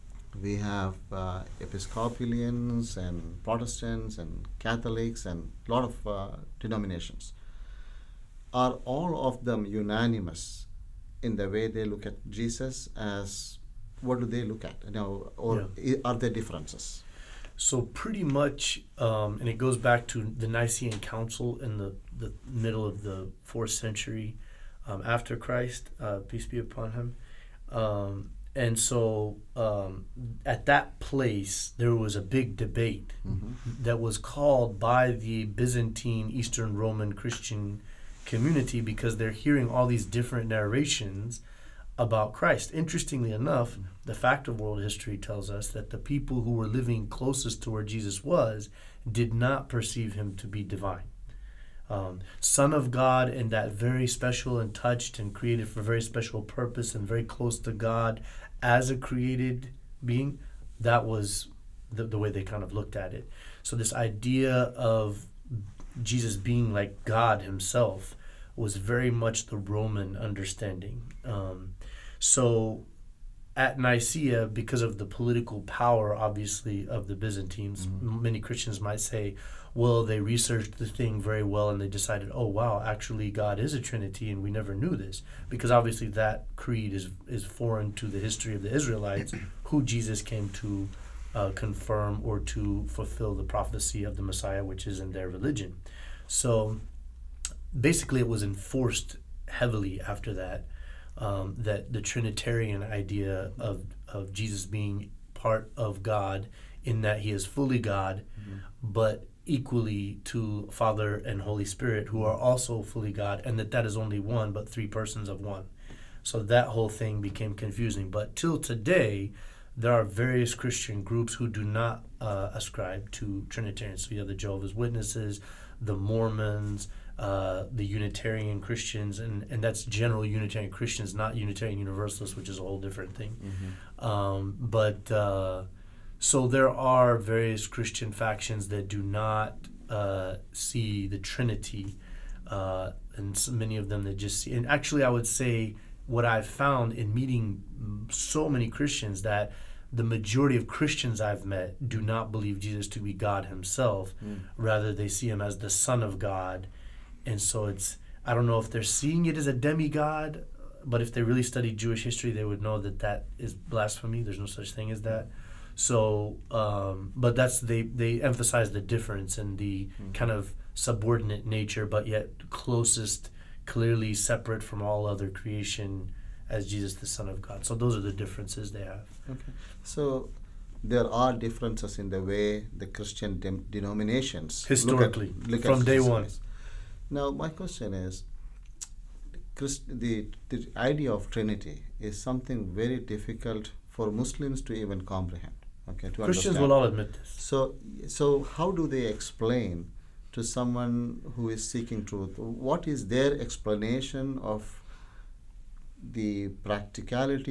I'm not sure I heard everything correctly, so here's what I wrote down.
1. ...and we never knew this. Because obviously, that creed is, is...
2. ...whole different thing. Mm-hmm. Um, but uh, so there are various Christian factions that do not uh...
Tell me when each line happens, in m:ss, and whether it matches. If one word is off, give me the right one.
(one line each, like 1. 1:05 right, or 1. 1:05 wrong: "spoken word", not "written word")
1. 1:24 right
2. 2:12 right.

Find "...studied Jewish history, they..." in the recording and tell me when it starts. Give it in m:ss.
2:41.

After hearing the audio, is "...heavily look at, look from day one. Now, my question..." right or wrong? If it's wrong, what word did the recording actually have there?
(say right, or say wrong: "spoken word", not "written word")
wrong: "historically", not "heavily".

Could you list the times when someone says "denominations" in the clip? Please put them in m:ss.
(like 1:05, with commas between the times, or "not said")
0:06, 3:03.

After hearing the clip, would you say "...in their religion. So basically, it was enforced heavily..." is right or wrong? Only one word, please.
right.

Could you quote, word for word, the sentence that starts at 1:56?
So that whole thing became confusing.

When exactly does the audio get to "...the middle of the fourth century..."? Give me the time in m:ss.
0:22.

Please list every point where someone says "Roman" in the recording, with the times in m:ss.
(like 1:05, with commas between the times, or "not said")
0:36, 1:09.